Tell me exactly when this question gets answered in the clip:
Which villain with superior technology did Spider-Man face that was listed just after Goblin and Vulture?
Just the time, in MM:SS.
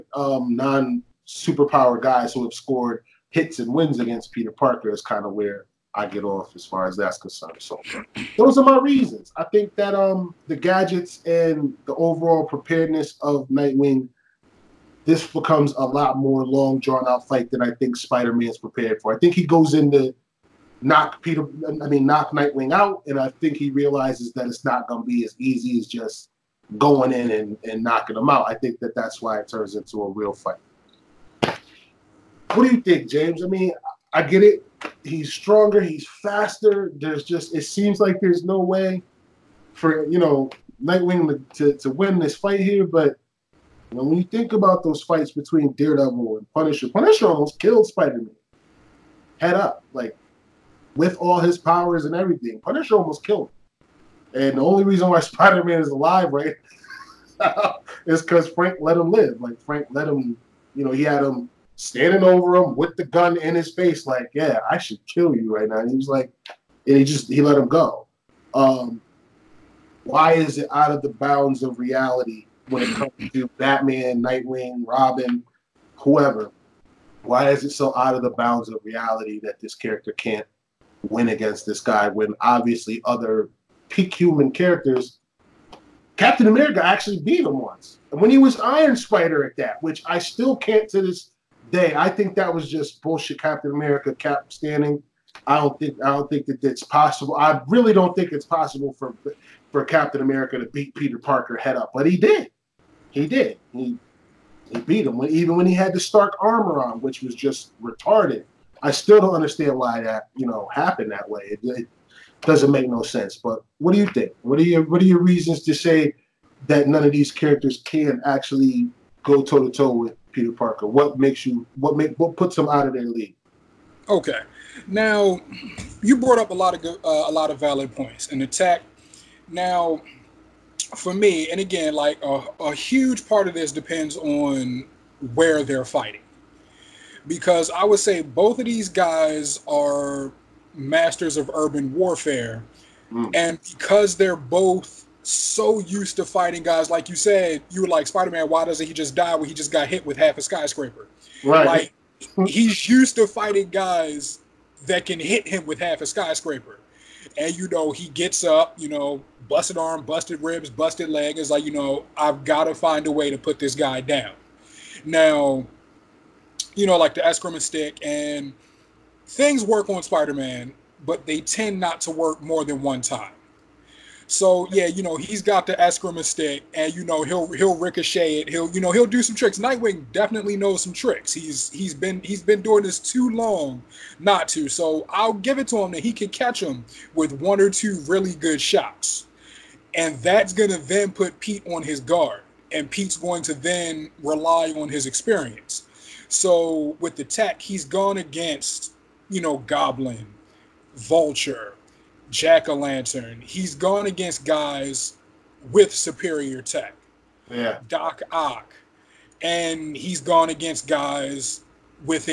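03:22.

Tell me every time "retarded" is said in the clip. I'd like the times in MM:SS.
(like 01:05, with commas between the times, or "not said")
01:47.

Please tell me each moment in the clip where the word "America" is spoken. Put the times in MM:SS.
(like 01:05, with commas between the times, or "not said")
01:26, 01:33, 01:40.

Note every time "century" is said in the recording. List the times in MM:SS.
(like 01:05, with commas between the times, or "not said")
not said.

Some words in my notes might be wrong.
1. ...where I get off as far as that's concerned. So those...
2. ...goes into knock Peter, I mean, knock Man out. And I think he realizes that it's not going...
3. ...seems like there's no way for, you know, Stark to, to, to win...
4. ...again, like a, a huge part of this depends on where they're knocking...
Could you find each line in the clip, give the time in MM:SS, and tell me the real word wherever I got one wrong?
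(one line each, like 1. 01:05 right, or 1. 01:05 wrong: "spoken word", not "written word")
1. 00:05 right
2. 00:19 wrong: "Nightwing", not "Man"
3. 00:37 wrong: "Nightwing", not "Stark"
4. 02:11 wrong: "fighting", not "knocking".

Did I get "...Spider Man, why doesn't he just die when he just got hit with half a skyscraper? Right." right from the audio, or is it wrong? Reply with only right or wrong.
right.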